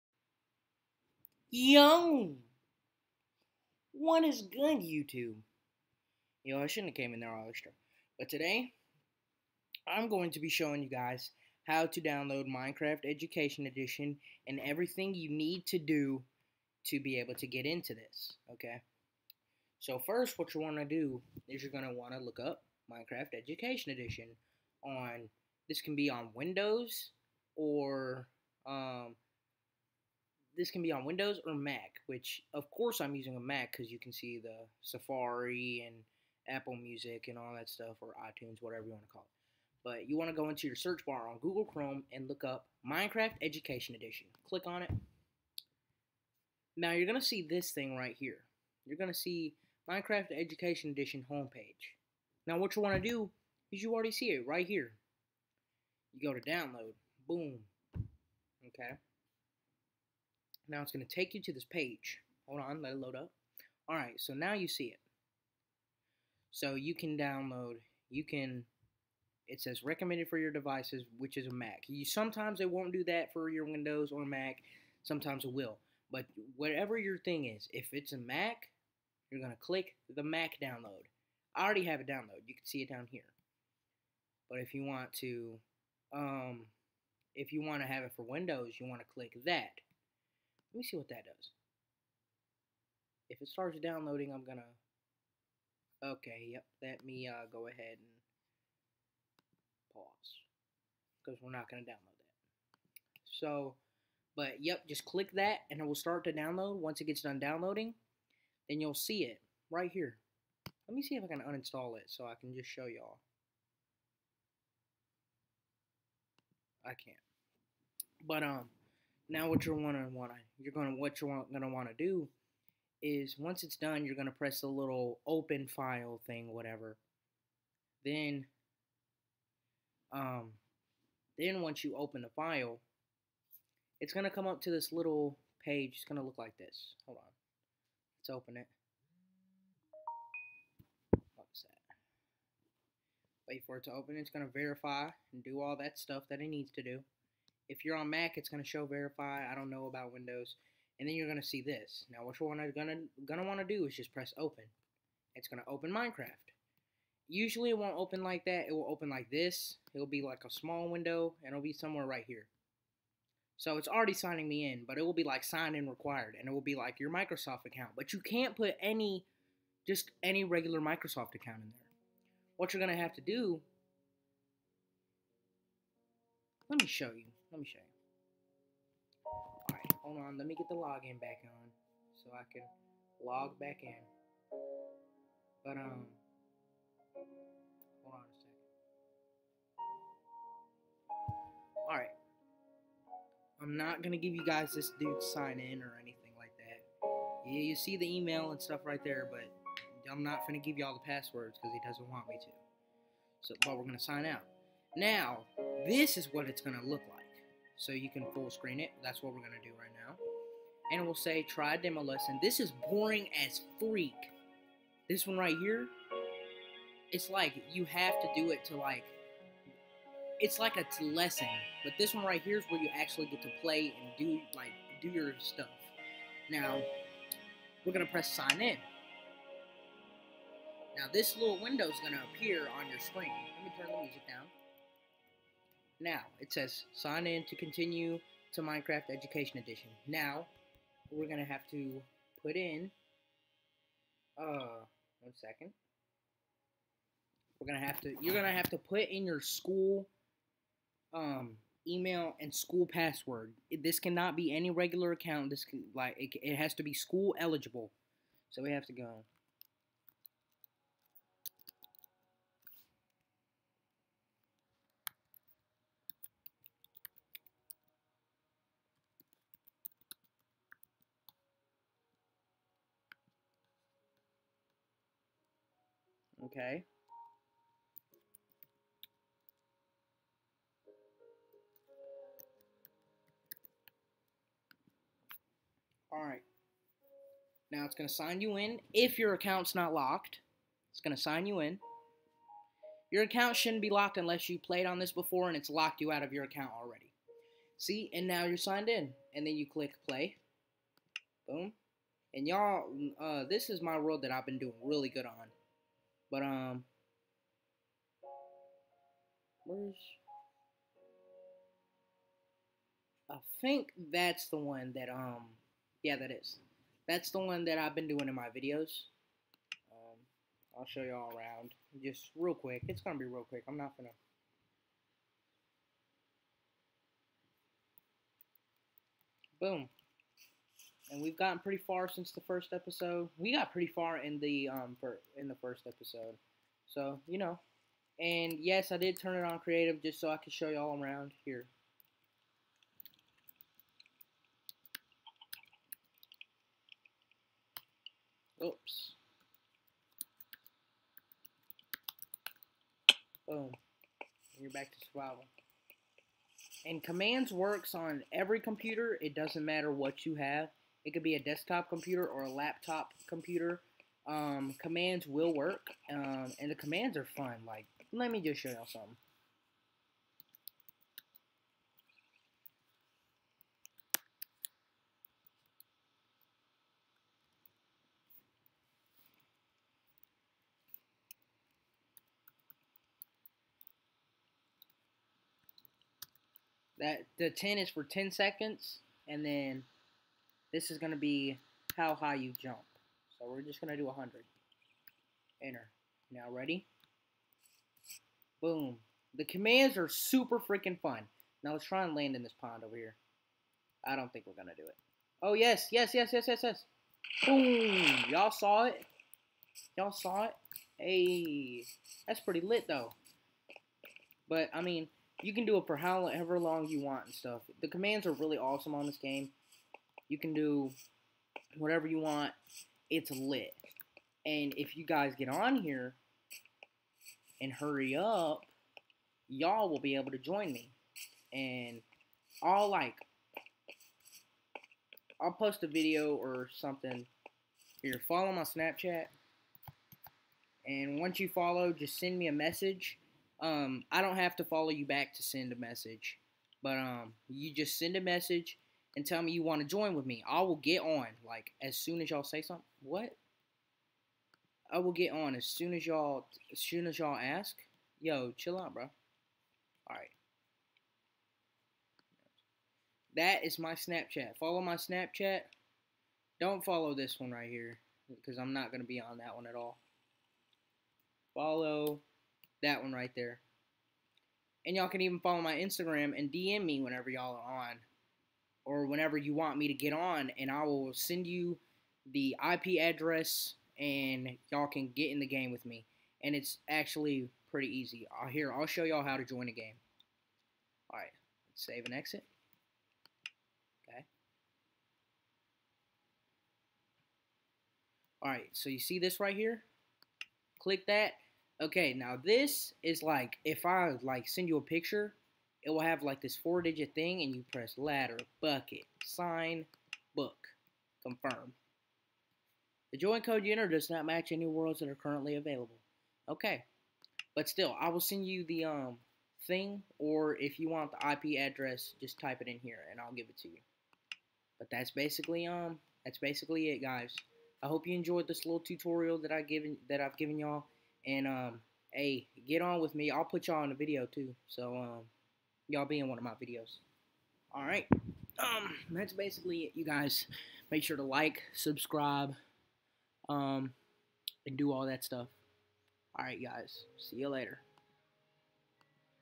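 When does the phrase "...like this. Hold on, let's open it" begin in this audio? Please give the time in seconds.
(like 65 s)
136 s.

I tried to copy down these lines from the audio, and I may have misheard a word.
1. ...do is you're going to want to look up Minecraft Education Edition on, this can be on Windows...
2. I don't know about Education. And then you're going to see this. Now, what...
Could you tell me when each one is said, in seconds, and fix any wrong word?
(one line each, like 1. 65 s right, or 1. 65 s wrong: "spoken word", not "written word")
1. 20 s right
2. 149 s wrong: "Windows", not "Education".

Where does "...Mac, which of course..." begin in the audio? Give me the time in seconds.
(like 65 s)
31 s.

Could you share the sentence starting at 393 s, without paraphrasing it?
So we're just going to do 100.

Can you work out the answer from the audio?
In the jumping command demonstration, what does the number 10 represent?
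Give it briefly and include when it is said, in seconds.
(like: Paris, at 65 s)
10 seconds, at 388 s.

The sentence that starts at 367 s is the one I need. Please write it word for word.
Like, let me just show y'all something.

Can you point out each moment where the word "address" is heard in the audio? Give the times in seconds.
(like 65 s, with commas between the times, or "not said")
482 s, 521 s.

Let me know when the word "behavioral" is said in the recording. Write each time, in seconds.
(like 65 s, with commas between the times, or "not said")
not said.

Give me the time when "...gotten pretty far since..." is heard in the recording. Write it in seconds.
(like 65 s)
331 s.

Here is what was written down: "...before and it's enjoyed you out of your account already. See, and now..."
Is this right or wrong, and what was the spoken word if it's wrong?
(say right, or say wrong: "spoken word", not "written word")
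wrong: "locked", not "enjoyed".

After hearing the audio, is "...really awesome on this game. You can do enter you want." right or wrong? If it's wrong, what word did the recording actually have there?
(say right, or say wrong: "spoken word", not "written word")
wrong: "whatever", not "enter".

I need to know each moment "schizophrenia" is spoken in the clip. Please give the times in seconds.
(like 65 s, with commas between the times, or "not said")
not said.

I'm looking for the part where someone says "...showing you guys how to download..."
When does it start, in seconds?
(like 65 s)
10 s.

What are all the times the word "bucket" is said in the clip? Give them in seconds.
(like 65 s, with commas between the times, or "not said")
508 s.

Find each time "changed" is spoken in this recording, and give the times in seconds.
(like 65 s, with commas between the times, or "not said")
not said.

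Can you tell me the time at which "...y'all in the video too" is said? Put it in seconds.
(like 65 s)
533 s.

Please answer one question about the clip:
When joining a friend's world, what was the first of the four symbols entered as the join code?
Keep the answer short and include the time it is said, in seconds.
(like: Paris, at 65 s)
Ladder, at 507 s.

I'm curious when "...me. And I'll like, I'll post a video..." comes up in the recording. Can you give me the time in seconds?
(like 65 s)
430 s.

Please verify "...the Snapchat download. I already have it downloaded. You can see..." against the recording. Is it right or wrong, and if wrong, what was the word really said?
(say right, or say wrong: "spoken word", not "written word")
wrong: "Mac", not "Snapchat".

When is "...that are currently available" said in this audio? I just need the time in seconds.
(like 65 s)
514 s.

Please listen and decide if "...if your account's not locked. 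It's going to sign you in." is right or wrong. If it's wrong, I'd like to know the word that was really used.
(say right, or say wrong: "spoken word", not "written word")
right.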